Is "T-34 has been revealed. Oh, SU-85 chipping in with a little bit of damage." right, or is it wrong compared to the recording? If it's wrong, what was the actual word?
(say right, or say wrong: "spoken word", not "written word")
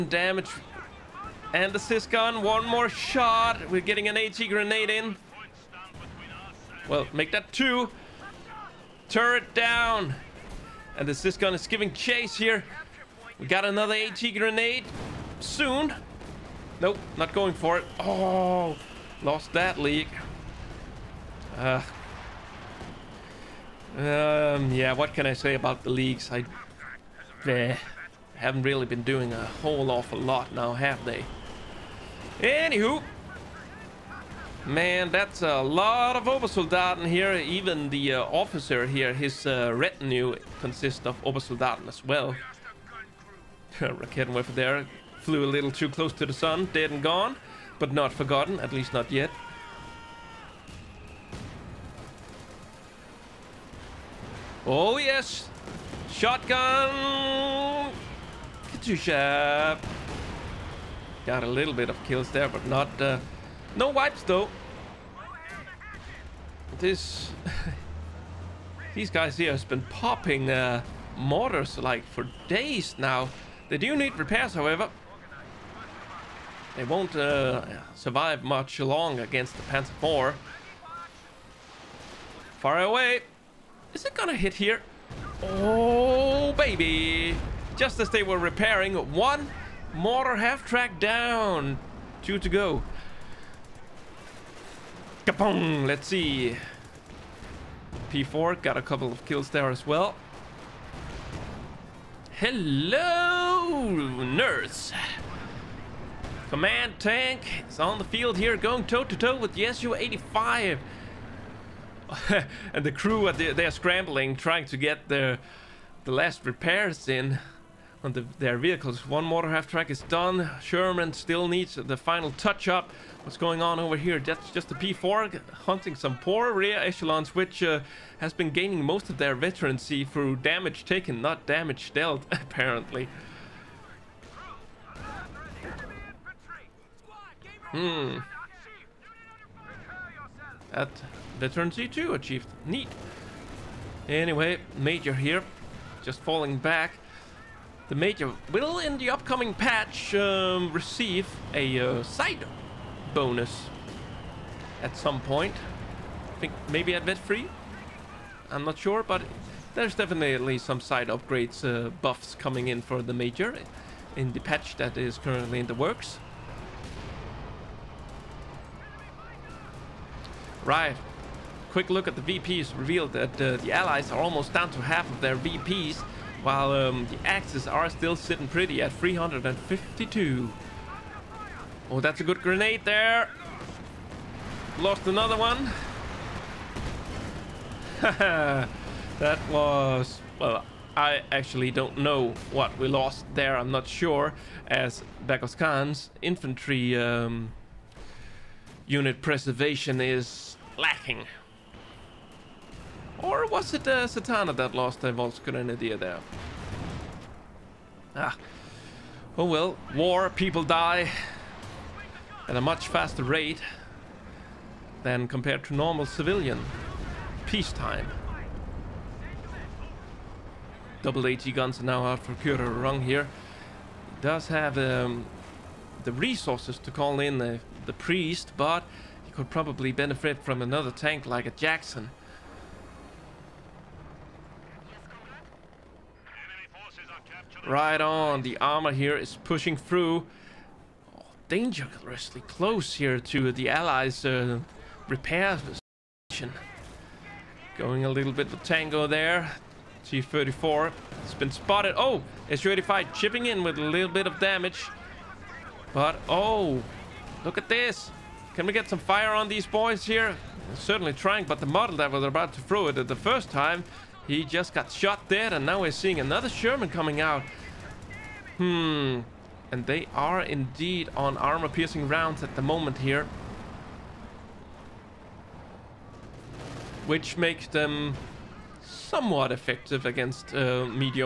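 wrong: "spotted", not "revealed".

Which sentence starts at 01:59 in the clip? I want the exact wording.
One mortar half track is done.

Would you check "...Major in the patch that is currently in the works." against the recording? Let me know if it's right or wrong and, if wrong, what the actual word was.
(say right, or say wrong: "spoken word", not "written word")
right.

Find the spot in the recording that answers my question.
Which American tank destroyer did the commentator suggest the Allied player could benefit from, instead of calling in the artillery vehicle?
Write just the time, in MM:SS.
03:51.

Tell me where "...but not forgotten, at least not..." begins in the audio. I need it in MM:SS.
00:47.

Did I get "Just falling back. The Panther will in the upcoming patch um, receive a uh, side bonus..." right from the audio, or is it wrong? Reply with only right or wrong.
wrong.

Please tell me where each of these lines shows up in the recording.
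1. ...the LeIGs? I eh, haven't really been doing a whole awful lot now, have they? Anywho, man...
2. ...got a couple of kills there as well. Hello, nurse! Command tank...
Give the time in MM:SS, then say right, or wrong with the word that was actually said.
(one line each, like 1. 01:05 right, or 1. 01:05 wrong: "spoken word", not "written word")
1. 00:25 right
2. 01:38 right.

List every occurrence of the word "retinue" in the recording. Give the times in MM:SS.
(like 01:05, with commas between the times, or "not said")
00:39.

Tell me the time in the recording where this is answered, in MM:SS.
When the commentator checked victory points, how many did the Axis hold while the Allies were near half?
02:58.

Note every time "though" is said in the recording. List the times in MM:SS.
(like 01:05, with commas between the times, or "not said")
01:04.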